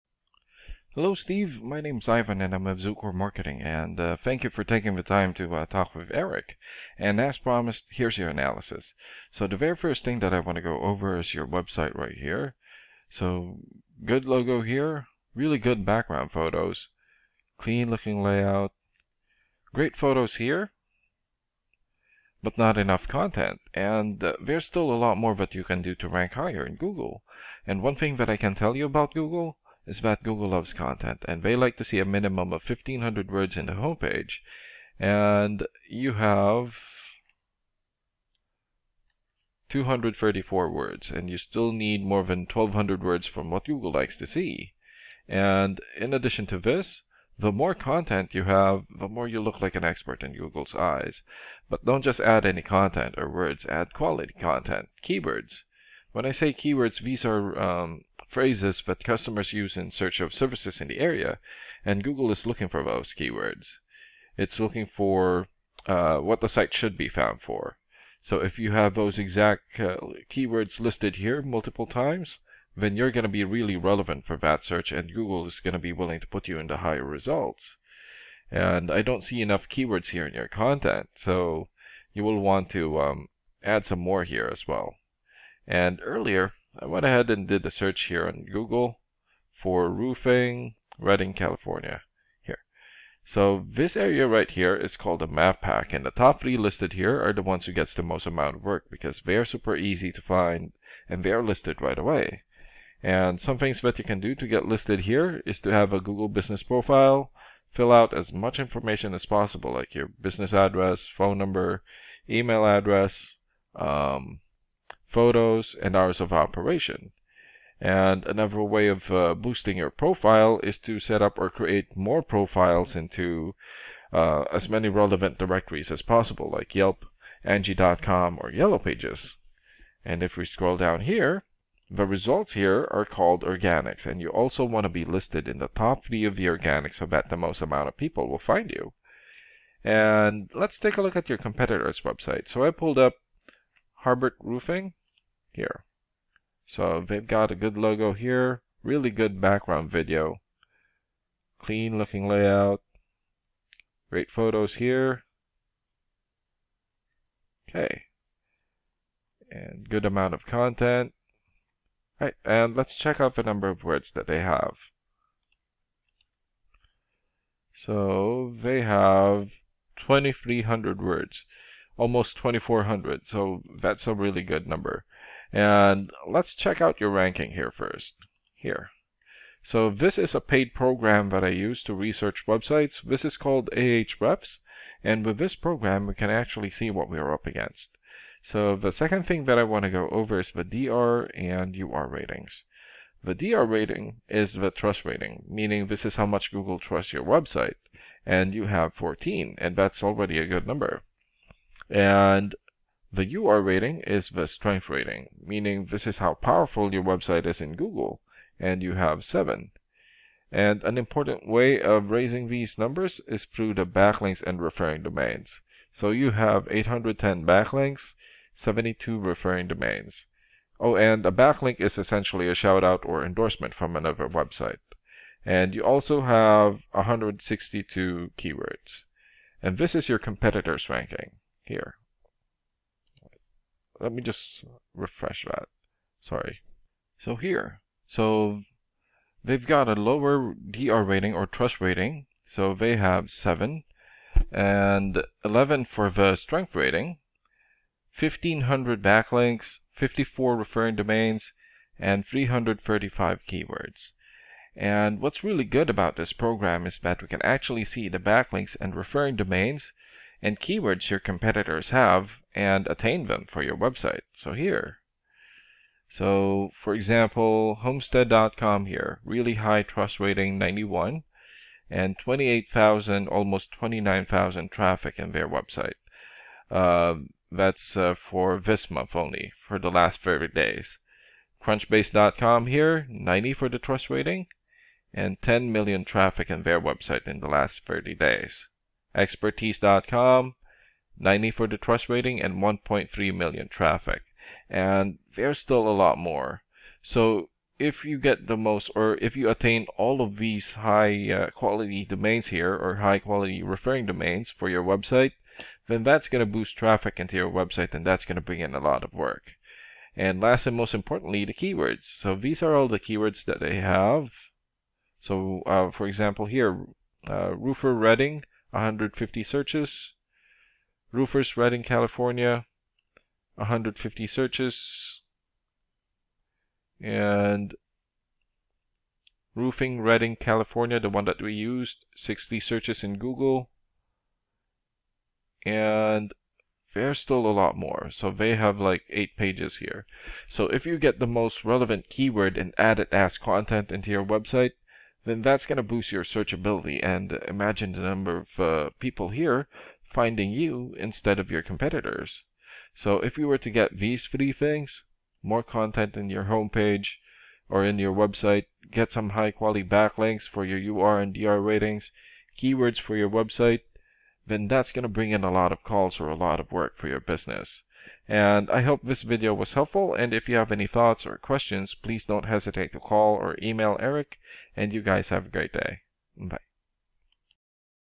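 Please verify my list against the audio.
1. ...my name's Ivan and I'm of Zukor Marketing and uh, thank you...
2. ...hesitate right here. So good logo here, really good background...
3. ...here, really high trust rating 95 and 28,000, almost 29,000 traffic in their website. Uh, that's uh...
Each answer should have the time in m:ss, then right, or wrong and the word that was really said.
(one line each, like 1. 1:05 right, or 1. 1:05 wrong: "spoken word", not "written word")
1. 0:01 right
2. 0:11 wrong: "website", not "hesitate"
3. 4:28 wrong: "91", not "95".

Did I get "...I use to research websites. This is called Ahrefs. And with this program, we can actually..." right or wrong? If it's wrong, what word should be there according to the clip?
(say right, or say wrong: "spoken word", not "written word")
right.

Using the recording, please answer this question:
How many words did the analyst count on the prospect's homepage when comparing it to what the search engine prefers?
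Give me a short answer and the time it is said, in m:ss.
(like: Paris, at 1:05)
234, at 0:39.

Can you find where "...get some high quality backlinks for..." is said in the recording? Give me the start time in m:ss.
5:58.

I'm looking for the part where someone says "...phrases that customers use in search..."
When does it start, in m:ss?
0:58.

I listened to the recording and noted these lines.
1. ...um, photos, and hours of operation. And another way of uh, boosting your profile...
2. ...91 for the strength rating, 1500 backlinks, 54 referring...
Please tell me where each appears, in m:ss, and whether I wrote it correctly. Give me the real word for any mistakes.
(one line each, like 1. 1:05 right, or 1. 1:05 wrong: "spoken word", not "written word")
1. 1:53 right
2. 4:05 wrong: "11", not "91".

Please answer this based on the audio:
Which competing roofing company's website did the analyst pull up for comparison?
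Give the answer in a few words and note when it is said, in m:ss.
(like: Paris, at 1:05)
Harbert Roofing, at 2:24.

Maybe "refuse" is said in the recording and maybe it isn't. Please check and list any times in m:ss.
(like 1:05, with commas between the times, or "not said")
not said.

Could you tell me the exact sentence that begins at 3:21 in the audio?
And the UR rating is the strength rating, meaning this is how powerful your website is in Google, and you have 7.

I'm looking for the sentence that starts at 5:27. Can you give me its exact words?
And Roofing Redding, California, the one that we used, 60 searches in Google.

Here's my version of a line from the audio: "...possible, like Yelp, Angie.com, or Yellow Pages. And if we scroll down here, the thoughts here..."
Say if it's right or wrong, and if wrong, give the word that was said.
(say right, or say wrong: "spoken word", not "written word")
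wrong: "results", not "thoughts".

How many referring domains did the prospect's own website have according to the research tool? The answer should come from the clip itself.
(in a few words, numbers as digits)
72.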